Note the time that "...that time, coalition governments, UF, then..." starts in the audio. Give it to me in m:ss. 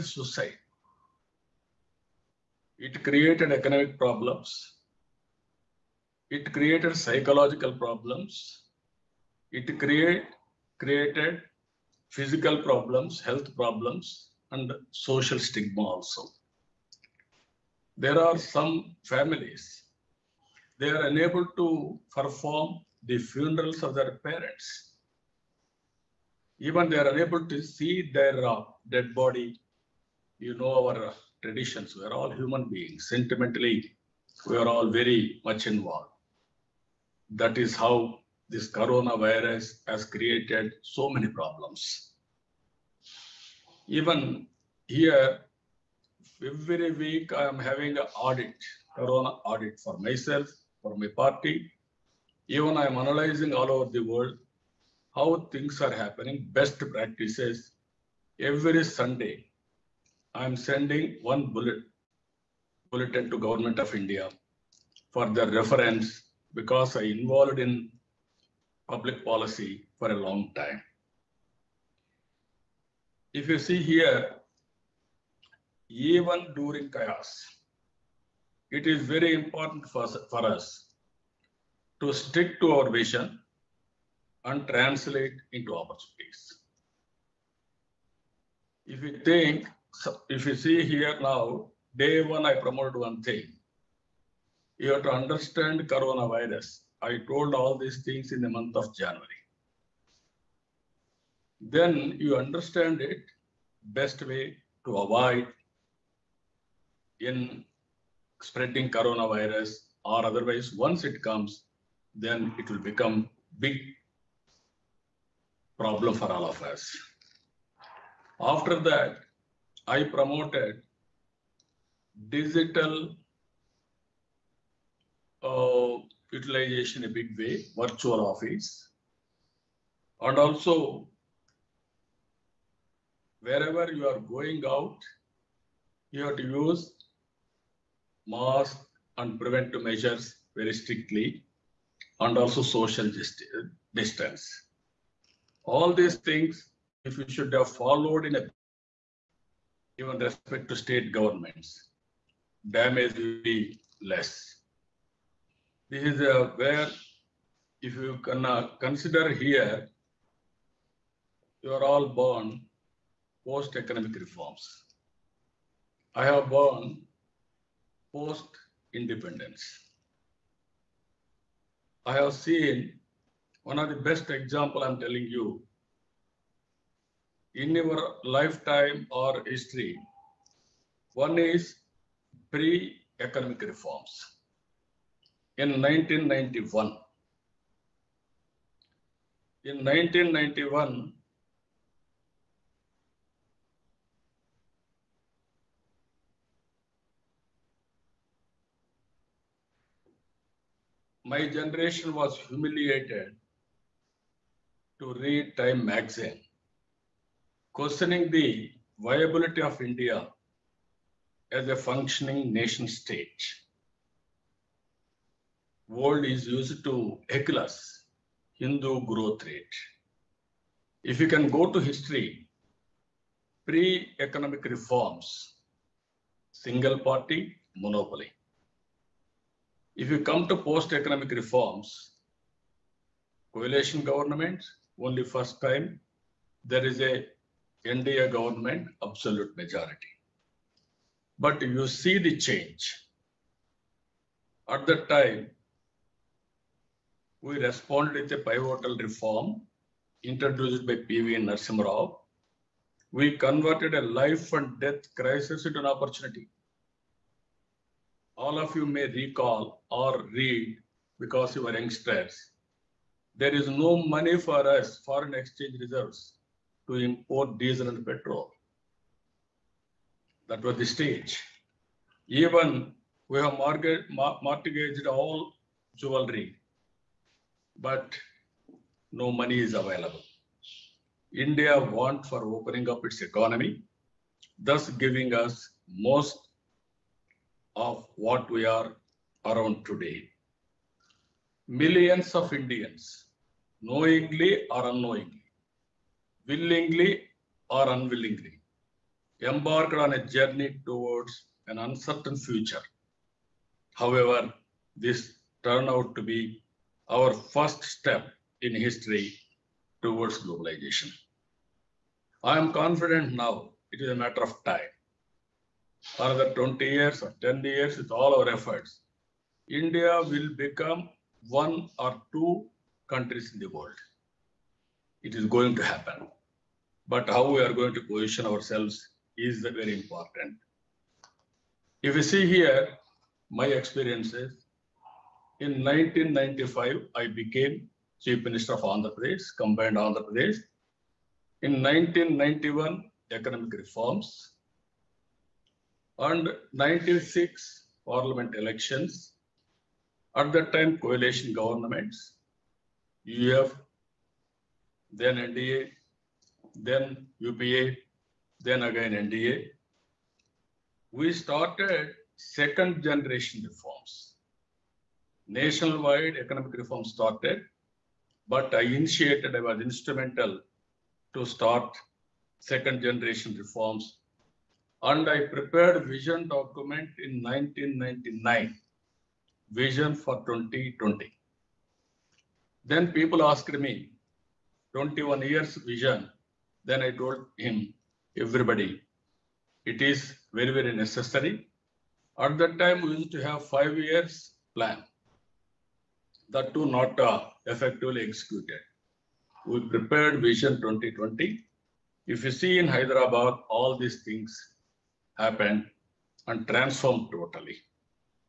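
5:50.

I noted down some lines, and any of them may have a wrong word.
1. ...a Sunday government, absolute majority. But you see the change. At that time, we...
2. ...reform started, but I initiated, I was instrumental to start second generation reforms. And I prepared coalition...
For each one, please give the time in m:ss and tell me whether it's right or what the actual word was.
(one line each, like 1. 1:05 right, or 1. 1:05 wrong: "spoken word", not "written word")
1. 3:57 wrong: "NDA", not "Sunday"
2. 6:06 wrong: "vision", not "coalition".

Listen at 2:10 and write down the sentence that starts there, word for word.
And also, wherever you are going out, you have to use mask and preventive measures very strictly and also social distance.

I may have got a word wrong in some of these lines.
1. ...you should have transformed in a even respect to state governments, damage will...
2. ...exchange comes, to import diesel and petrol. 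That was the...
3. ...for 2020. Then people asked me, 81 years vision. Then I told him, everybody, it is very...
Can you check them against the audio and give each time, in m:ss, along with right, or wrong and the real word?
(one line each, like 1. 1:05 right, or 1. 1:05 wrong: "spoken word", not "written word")
1. 2:27 wrong: "followed", not "transformed"
2. 4:25 wrong: "reserves", not "comes"
3. 6:20 wrong: "21", not "81".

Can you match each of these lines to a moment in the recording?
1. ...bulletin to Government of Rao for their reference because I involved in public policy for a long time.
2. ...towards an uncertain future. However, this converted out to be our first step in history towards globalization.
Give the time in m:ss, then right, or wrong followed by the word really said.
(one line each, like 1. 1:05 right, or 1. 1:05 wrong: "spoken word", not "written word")
1. 1:02 wrong: "India", not "Rao"
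2. 5:00 wrong: "turned", not "converted".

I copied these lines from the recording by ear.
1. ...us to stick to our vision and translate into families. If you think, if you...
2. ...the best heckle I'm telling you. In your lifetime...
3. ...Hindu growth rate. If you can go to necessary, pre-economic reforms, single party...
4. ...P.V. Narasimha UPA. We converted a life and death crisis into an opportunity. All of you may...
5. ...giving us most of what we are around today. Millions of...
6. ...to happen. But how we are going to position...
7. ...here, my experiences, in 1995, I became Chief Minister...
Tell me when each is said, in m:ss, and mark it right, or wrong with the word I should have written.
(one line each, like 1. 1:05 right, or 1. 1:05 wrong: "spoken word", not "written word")
1. 1:20 wrong: "opportunities", not "families"
2. 2:53 wrong: "example", not "heckle"
3. 3:38 wrong: "history", not "necessary"
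4. 4:11 wrong: "Rao", not "UPA"
5. 4:45 right
6. 5:25 right
7. 5:32 right.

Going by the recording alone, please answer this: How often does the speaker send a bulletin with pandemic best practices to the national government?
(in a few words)
Every Sunday.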